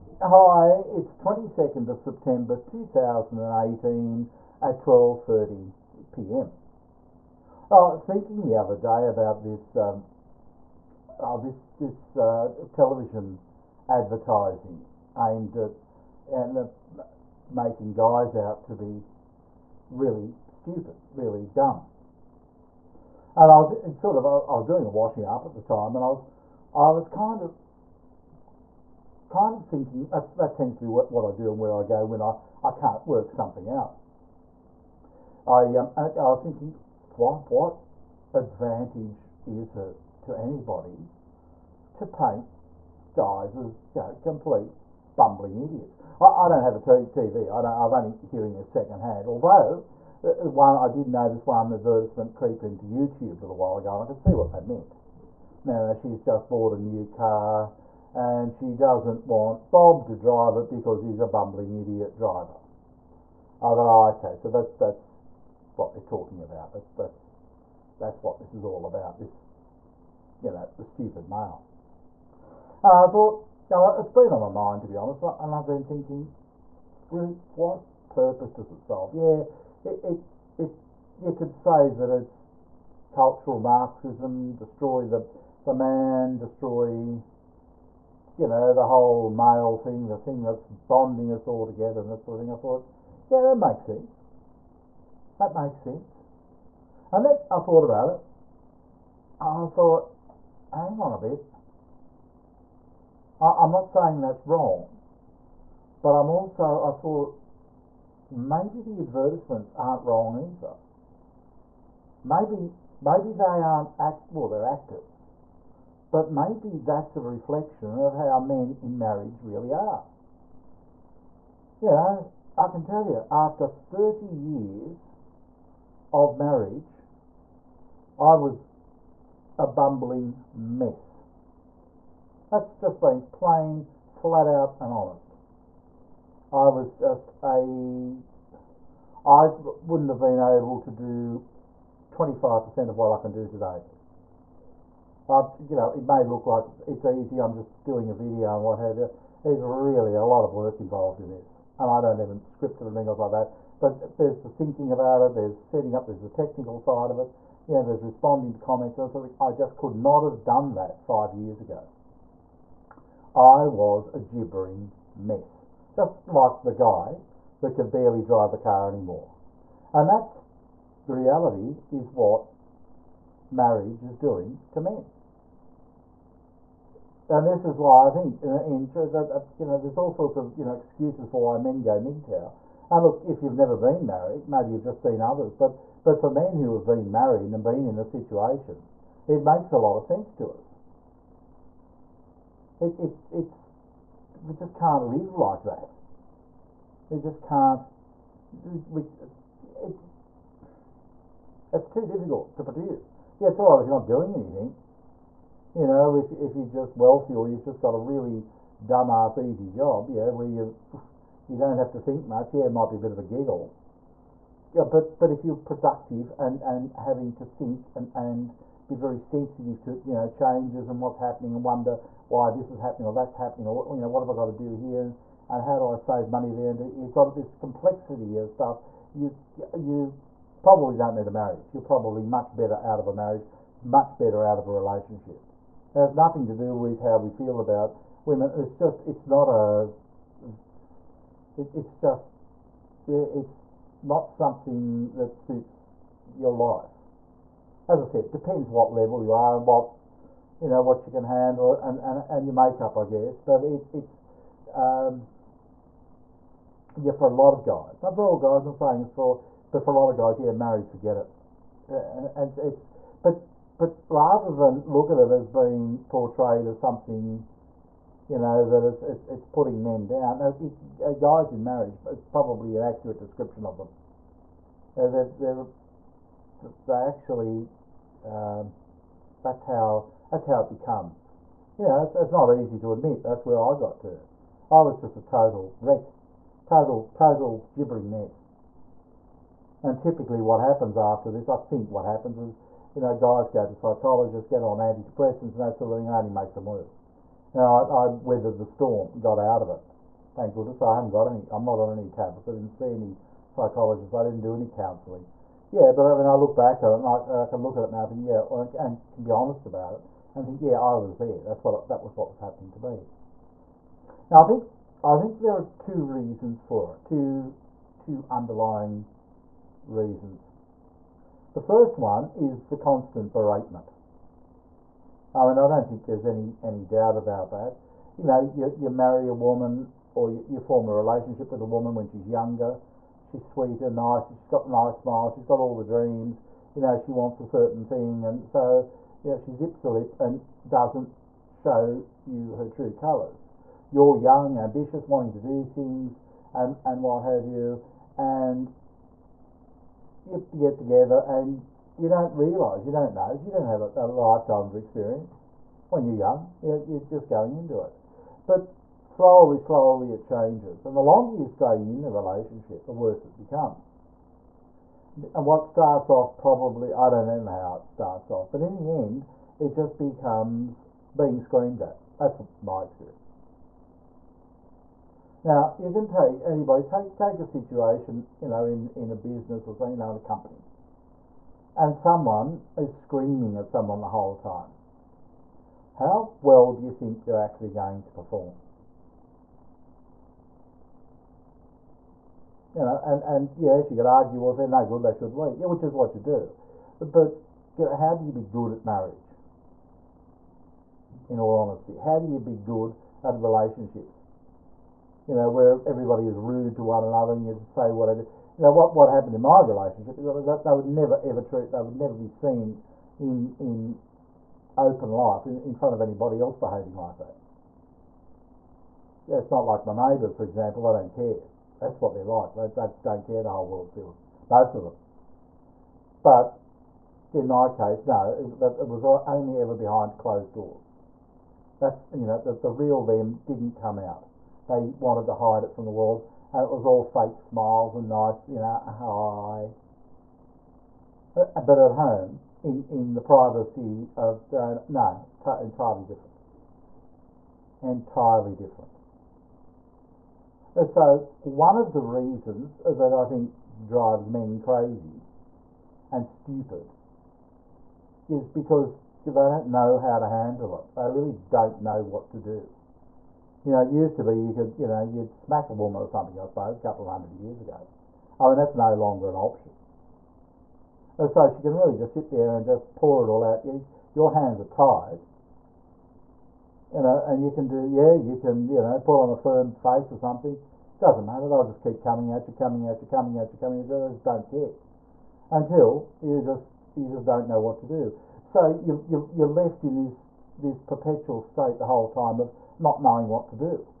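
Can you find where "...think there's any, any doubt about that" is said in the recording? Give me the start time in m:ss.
5:25.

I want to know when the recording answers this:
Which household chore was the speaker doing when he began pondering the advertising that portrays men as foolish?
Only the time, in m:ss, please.
0:24.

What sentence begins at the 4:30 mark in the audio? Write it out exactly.
It, guys in marriage, it's probably an accurate description of them.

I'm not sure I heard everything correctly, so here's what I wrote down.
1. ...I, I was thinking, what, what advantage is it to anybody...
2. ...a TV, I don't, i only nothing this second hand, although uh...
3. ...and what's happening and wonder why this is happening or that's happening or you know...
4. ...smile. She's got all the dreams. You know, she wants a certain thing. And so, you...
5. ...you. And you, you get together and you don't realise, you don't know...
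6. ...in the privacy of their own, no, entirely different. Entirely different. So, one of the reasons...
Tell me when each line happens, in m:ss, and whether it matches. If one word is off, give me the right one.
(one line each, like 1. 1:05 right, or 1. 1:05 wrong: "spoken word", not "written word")
1. 0:35 right
2. 0:46 wrong: "hearing", not "nothing"
3. 3:40 right
4. 5:34 right
5. 5:47 right
6. 7:22 right.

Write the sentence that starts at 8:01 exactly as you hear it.
They'll just keep coming at you, coming at you, coming at you, coming at you.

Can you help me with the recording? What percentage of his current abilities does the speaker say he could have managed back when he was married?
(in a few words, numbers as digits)
25%.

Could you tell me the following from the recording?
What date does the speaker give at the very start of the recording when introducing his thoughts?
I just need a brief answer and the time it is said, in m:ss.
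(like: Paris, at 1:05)
22 September 2018, at 0:01.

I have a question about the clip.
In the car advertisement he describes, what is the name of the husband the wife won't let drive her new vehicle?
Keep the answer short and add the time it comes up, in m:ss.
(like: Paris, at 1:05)
Bob, at 0:59.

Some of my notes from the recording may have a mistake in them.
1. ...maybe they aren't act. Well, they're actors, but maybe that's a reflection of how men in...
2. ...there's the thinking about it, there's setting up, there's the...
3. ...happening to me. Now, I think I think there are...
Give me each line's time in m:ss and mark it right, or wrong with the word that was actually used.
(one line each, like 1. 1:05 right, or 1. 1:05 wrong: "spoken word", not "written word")
1. 1:52 right
2. 2:34 right
3. 5:12 right.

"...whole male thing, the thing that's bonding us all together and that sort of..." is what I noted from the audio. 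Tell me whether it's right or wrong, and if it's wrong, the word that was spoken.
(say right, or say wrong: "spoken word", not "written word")
right.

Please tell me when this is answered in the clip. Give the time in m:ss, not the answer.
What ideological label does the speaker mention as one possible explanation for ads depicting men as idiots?
1:23.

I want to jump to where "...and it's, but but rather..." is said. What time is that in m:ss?
4:22.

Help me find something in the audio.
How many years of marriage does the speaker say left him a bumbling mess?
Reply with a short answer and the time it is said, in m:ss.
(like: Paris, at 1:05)
30, at 2:03.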